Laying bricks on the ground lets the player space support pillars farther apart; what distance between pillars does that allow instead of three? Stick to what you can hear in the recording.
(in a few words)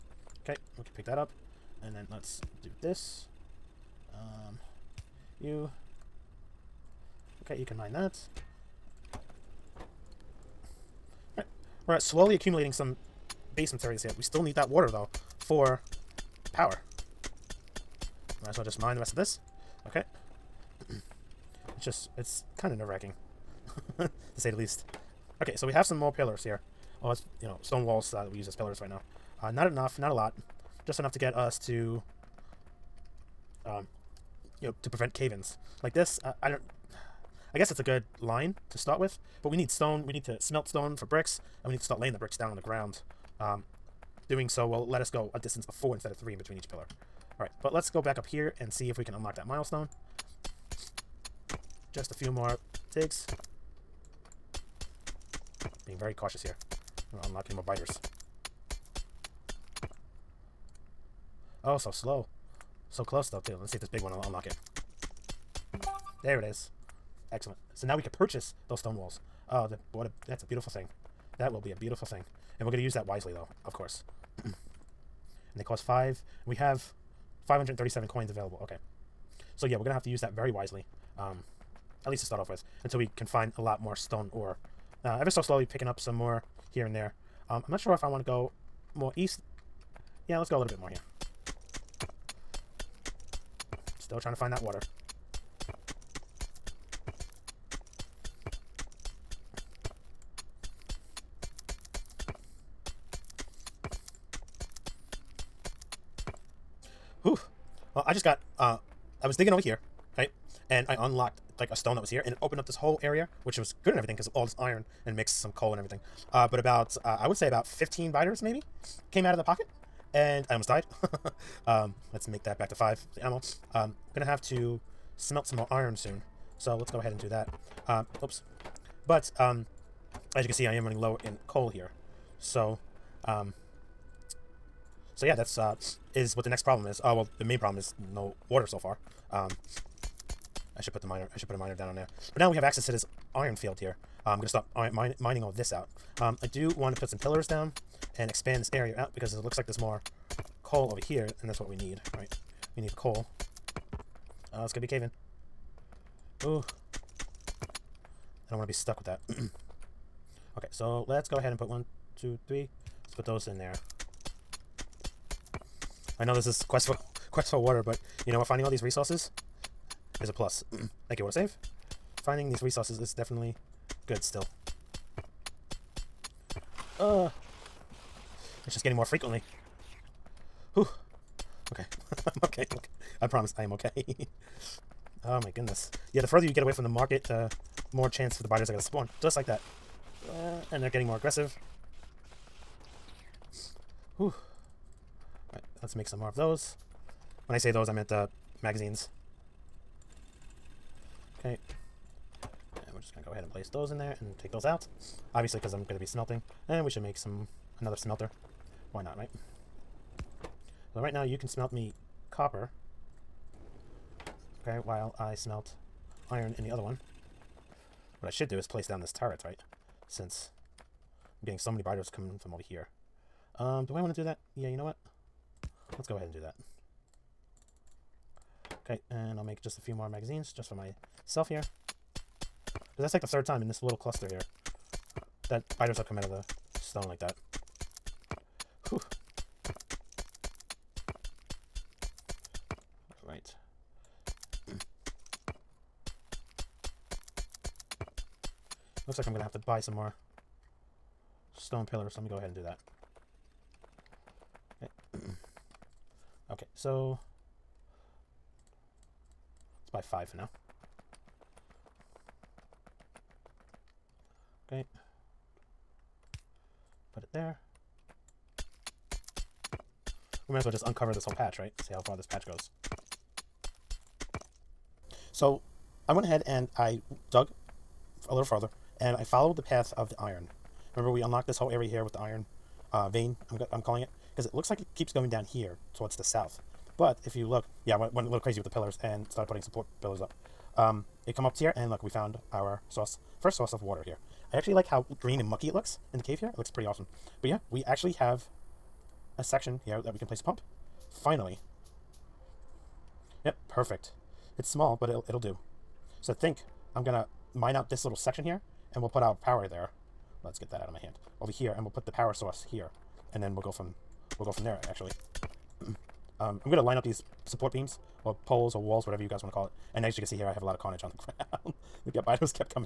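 4.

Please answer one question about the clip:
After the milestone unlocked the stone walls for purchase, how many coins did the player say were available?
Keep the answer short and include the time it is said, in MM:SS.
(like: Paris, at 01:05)
537, at 01:17.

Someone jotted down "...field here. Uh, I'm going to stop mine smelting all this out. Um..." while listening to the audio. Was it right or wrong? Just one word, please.
wrong.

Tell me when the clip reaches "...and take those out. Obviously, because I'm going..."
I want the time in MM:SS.
03:24.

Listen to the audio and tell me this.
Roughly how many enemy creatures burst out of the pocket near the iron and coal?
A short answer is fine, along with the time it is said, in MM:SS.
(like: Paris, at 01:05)
15, at 01:57.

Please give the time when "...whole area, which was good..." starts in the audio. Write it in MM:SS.
01:52.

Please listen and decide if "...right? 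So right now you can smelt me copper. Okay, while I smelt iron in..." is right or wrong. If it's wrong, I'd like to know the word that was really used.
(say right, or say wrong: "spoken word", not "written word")
right.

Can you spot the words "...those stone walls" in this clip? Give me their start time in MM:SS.
01:08.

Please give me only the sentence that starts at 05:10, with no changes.
Let's get that out of my hand.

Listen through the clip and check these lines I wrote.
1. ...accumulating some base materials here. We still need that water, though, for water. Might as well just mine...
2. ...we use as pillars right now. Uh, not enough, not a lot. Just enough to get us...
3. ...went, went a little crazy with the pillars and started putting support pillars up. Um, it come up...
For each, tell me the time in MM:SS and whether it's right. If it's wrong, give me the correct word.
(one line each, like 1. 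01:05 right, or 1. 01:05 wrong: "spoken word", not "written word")
1. 00:12 wrong: "power", not "water"
2. 00:28 right
3. 04:47 right.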